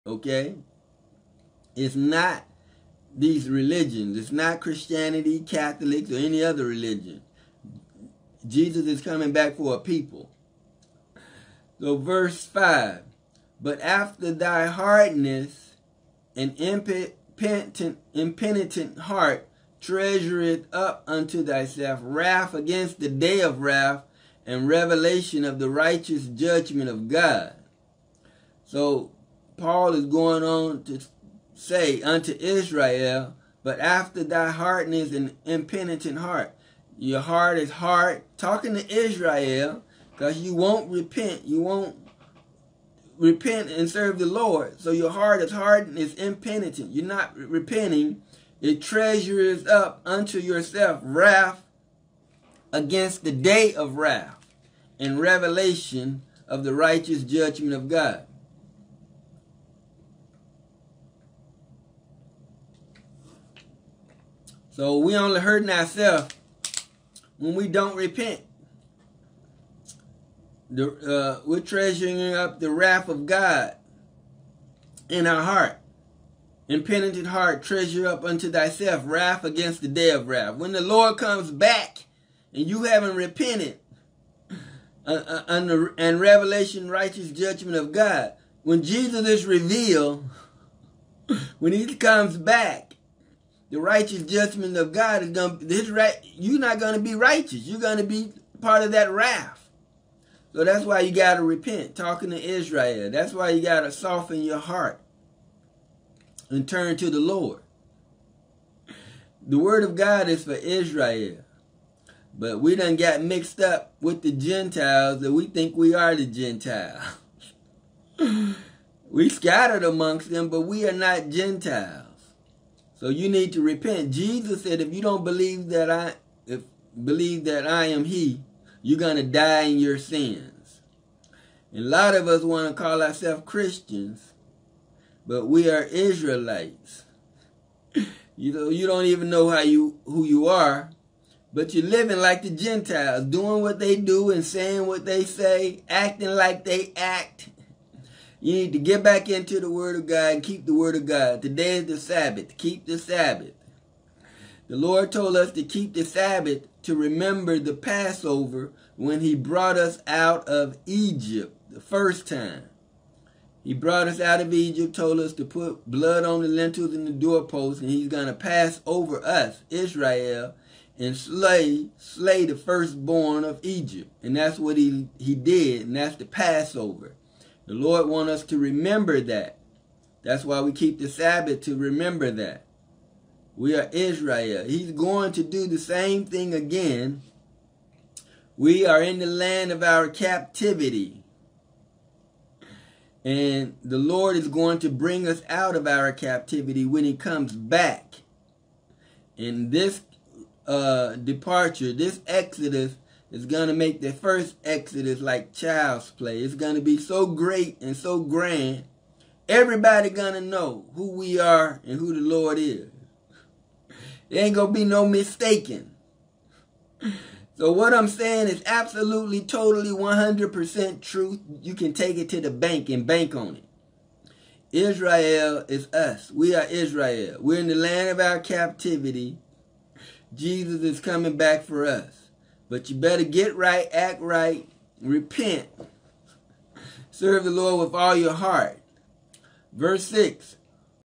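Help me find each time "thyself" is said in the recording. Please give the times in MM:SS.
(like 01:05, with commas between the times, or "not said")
00:21, 01:18.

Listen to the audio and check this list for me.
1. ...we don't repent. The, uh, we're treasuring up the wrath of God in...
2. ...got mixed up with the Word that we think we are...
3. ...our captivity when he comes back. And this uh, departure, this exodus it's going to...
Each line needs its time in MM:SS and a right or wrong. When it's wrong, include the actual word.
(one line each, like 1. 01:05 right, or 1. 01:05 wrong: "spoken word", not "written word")
1. 01:07 right
2. 01:52 wrong: "Gentiles", not "Word"
3. 03:15 right.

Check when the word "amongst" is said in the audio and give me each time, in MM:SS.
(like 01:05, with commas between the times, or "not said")
01:59.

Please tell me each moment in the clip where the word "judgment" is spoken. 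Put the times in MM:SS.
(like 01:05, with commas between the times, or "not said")
00:26, 00:57, 01:27, 01:34.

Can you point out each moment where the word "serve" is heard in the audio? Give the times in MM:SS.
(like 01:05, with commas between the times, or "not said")
00:43, 03:57.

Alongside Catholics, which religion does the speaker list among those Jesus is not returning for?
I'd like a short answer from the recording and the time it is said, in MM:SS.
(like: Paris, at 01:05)
Christianity, at 00:04.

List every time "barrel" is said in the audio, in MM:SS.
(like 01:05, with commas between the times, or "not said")
not said.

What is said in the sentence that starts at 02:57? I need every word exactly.
The Lord wants us to remember that.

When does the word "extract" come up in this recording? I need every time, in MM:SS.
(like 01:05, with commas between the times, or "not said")
not said.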